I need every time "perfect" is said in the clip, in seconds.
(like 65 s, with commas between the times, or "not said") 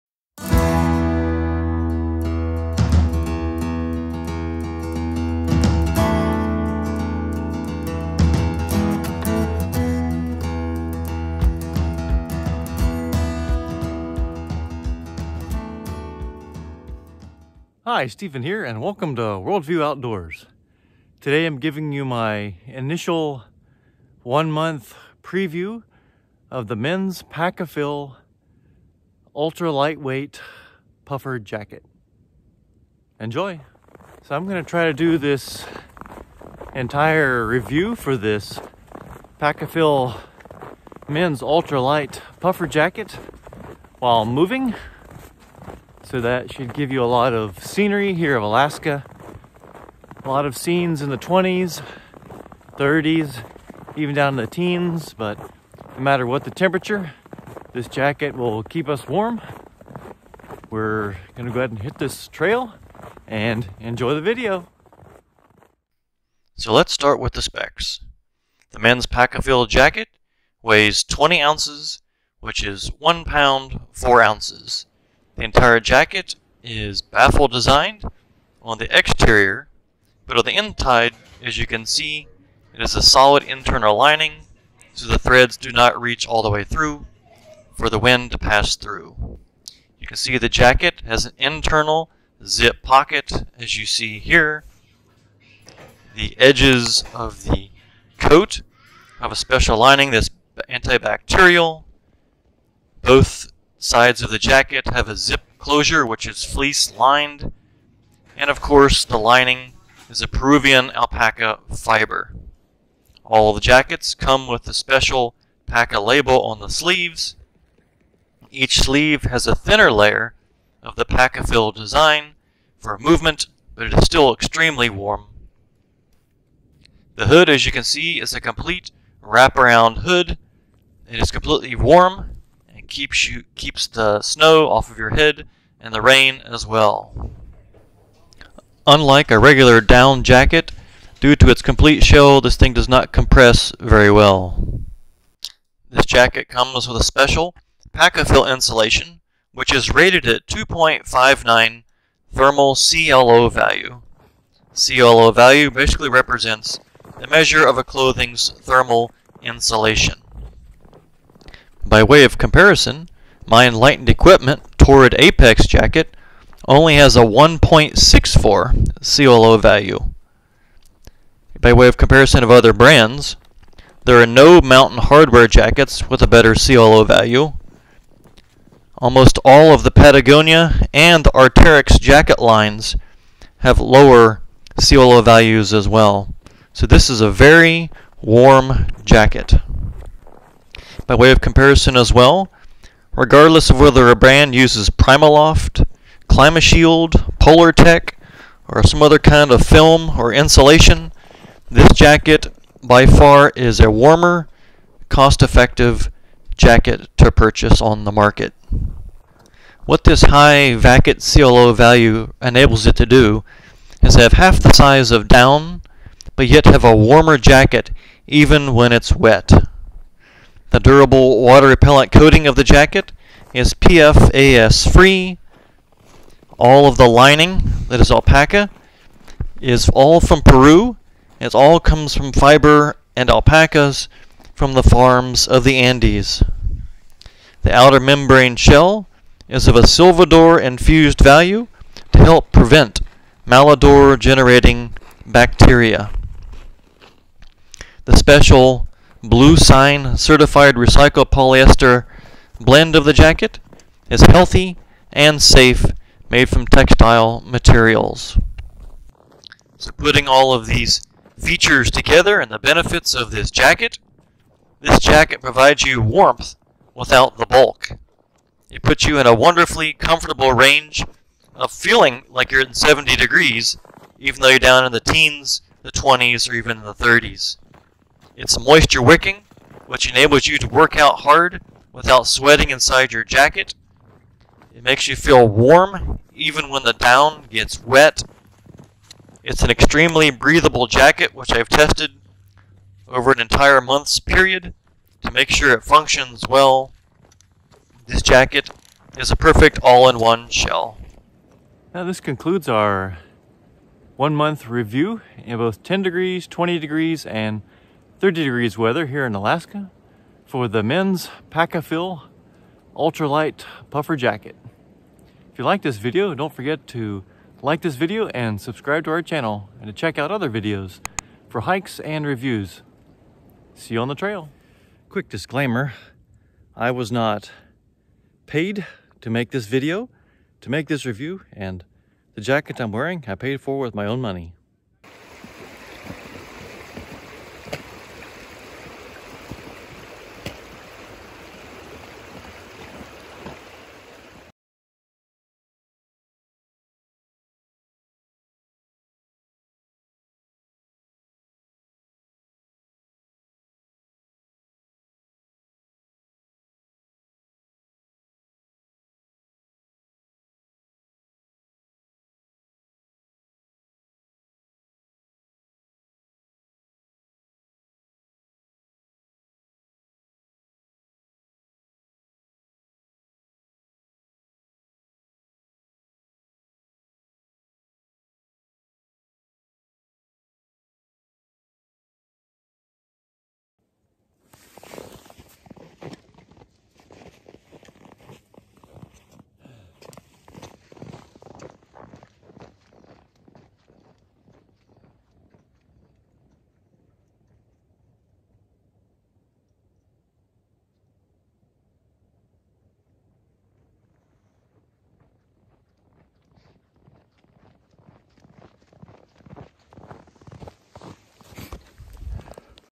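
299 s.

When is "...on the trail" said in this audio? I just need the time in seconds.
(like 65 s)
324 s.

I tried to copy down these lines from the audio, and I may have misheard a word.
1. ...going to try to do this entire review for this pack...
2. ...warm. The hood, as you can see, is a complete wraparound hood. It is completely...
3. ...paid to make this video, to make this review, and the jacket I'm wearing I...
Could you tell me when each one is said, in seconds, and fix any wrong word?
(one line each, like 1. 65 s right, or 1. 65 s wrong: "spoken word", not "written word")
1. 34 s right
2. 124 s right
3. 328 s right.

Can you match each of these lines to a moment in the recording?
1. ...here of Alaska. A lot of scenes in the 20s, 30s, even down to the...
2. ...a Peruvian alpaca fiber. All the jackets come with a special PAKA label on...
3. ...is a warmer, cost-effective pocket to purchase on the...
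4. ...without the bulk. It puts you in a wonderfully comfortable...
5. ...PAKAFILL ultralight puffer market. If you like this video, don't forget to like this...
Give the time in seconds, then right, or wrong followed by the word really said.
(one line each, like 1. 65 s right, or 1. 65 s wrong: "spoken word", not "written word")
1. 48 s right
2. 110 s right
3. 203 s wrong: "jacket", not "pocket"
4. 266 s right
5. 311 s wrong: "jacket", not "market".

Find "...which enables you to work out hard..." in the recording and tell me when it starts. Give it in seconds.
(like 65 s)
279 s.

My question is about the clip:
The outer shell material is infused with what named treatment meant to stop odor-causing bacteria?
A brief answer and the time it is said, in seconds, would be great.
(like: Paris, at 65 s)
Silvadur, at 239 s.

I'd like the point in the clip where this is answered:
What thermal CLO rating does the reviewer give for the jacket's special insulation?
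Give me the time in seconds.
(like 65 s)
150 s.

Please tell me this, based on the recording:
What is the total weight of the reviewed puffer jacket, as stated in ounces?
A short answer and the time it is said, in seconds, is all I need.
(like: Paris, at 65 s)
20 ounces, at 71 s.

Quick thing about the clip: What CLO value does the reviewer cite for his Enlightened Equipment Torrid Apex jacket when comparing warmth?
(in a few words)
1.64.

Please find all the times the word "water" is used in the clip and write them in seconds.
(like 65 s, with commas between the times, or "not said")
221 s.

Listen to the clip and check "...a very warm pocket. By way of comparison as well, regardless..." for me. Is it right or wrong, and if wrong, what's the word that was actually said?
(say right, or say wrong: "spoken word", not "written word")
wrong: "jacket", not "pocket".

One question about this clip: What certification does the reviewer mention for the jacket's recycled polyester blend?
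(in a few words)
bluesign.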